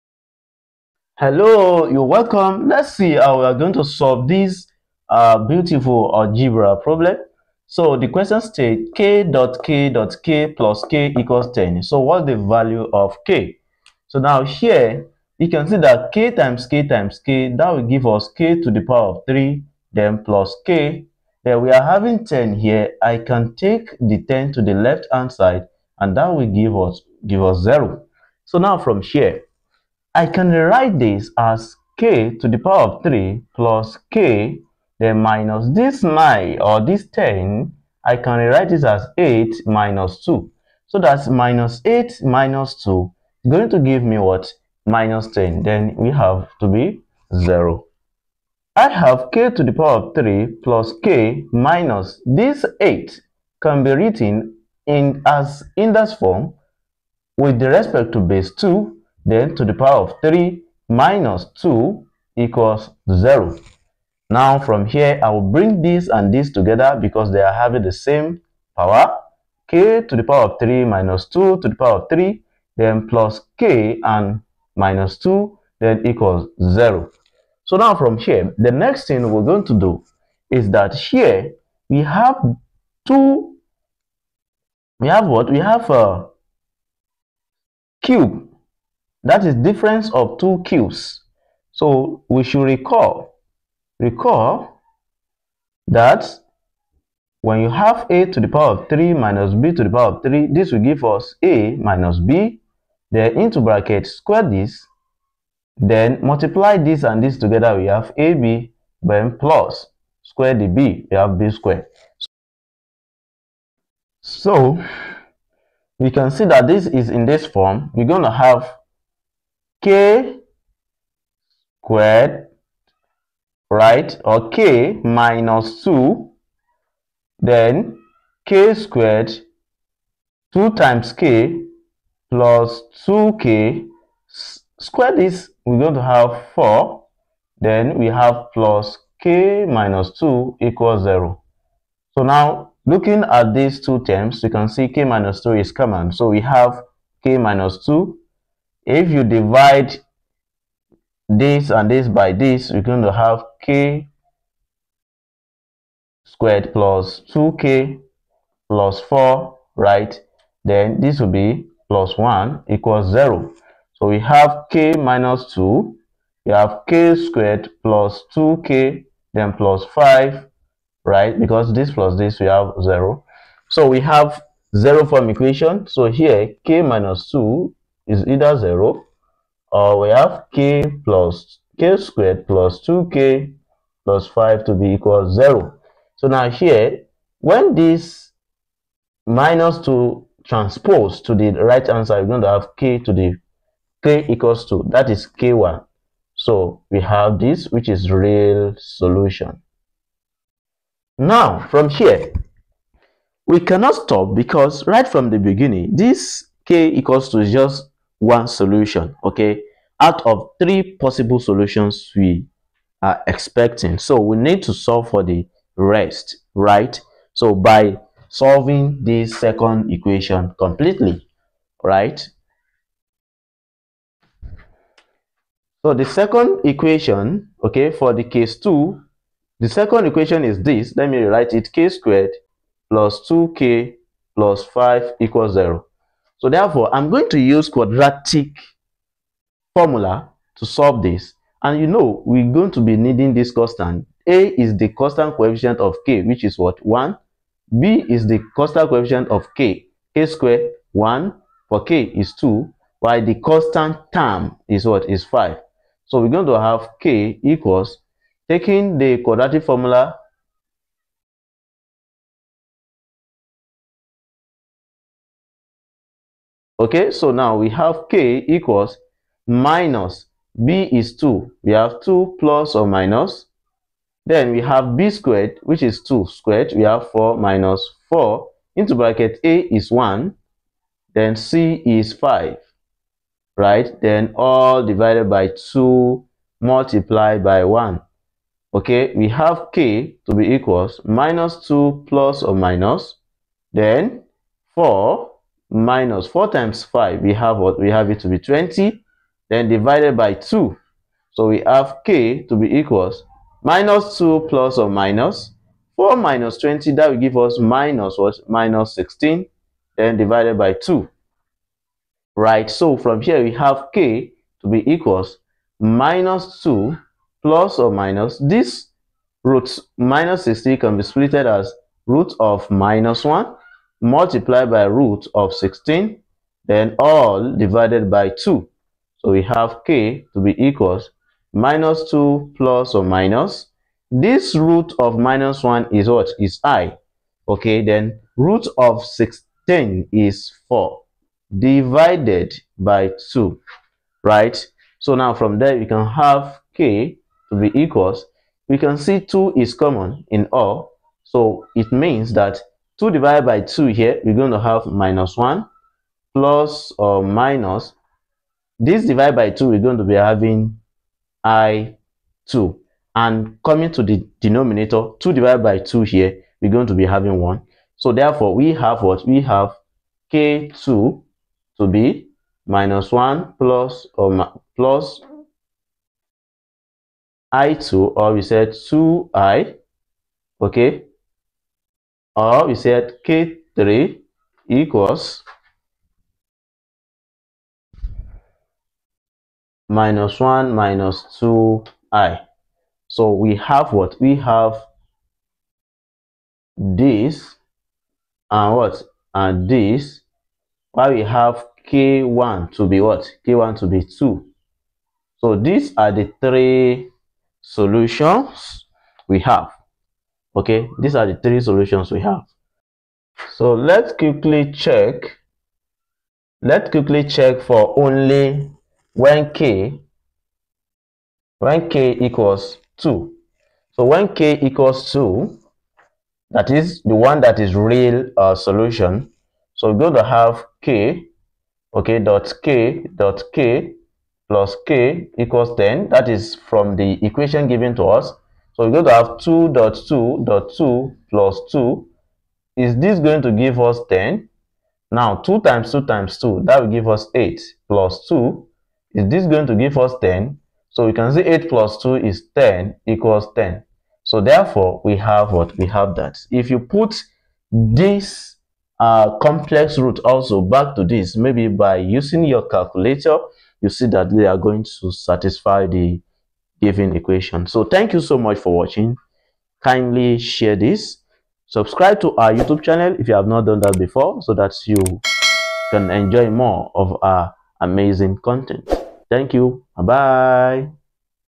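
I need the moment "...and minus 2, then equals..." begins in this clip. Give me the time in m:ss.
1:14.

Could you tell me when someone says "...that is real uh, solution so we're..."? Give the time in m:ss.
7:07.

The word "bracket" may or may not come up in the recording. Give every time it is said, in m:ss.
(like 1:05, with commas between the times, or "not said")
1:43, 4:38.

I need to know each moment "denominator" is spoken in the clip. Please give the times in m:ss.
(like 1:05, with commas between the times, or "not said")
6:04.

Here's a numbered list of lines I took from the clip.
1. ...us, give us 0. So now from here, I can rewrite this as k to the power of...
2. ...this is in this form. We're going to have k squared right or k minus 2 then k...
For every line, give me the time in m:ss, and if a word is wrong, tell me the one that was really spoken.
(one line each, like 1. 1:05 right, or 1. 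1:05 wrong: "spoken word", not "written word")
1. 0:26 right
2. 1:56 right.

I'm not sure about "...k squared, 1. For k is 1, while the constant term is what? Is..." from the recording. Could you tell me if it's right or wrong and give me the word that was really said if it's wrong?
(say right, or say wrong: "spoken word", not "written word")
wrong: "2", not "1".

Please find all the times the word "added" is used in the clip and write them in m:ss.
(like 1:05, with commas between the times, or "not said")
not said.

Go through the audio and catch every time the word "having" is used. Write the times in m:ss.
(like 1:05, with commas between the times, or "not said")
0:21, 1:07, 6:00, 6:07.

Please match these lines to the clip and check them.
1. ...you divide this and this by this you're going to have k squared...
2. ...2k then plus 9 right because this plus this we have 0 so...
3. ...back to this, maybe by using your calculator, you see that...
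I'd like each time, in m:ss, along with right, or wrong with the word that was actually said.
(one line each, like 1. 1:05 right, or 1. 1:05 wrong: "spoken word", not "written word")
1. 2:29 right
2. 2:48 wrong: "5", not "9"
3. 7:40 right.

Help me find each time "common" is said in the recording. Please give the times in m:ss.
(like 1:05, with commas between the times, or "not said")
2:25, 5:49.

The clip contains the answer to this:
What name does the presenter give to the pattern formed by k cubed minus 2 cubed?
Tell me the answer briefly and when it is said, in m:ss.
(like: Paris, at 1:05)
difference of two cubes, at 1:29.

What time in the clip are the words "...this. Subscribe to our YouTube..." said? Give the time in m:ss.
7:50.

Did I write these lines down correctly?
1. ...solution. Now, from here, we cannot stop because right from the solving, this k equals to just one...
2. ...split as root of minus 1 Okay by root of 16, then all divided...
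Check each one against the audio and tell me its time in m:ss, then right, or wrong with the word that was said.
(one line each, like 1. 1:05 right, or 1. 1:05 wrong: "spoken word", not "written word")
1. 3:18 wrong: "beginning", not "solving"
2. 5:21 wrong: "Multiply", not "Okay".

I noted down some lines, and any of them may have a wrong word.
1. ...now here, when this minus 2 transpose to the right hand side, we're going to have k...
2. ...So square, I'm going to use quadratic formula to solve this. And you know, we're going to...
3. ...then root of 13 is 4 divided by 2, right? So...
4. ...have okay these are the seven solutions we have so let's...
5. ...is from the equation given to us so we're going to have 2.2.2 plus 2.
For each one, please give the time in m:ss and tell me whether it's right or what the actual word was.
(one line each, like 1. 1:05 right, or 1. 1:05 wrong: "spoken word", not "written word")
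1. 3:06 right
2. 3:56 wrong: "therefore", not "square"
3. 5:37 wrong: "16", not "13"
4. 6:49 wrong: "three", not "seven"
5. 7:16 right.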